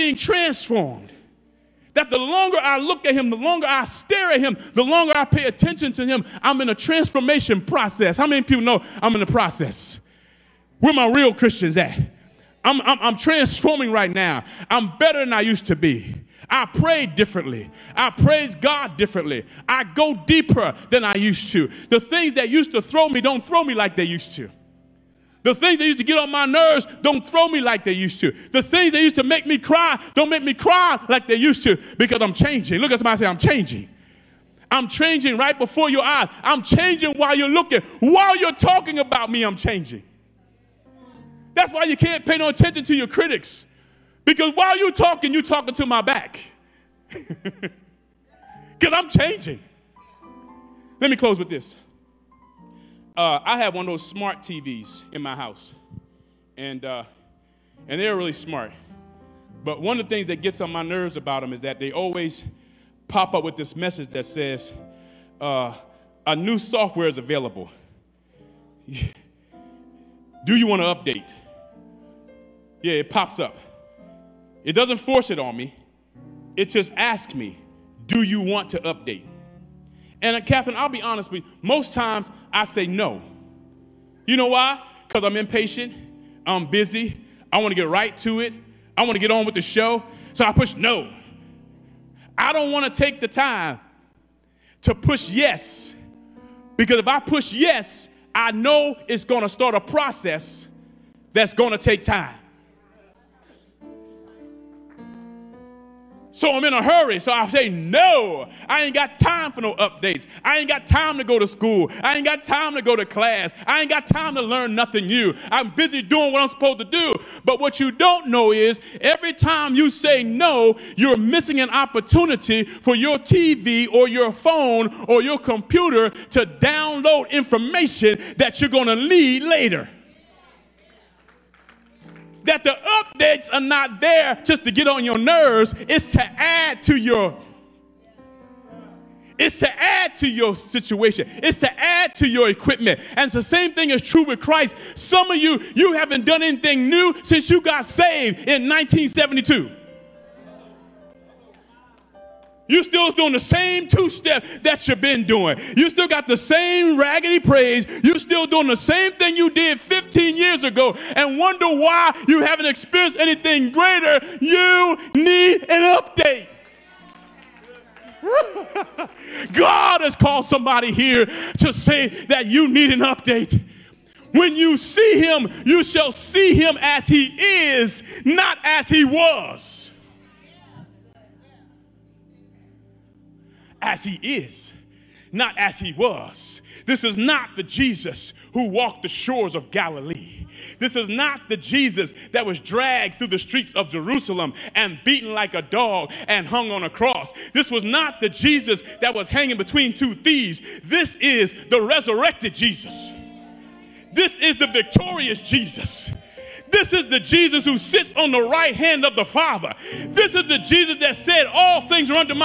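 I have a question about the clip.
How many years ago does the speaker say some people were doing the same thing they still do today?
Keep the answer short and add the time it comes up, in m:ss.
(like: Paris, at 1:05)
15, at 2:39.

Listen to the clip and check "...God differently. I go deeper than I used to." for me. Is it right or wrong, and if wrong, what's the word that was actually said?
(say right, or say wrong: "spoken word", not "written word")
right.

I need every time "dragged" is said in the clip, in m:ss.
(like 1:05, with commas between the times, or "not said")
3:12.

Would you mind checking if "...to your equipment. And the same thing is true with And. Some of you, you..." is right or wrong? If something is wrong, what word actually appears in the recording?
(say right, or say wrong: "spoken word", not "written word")
wrong: "Christ", not "And".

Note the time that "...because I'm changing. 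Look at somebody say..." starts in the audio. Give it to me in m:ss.
0:31.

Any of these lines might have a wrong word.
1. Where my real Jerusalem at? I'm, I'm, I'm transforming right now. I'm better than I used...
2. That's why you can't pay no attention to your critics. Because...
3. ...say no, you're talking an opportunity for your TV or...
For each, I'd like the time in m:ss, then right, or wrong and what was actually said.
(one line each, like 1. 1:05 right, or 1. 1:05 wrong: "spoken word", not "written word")
1. 0:10 wrong: "Christians", not "Jerusalem"
2. 0:41 right
3. 1:59 wrong: "missing", not "talking".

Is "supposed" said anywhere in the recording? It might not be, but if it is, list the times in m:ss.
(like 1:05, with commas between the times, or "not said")
1:56.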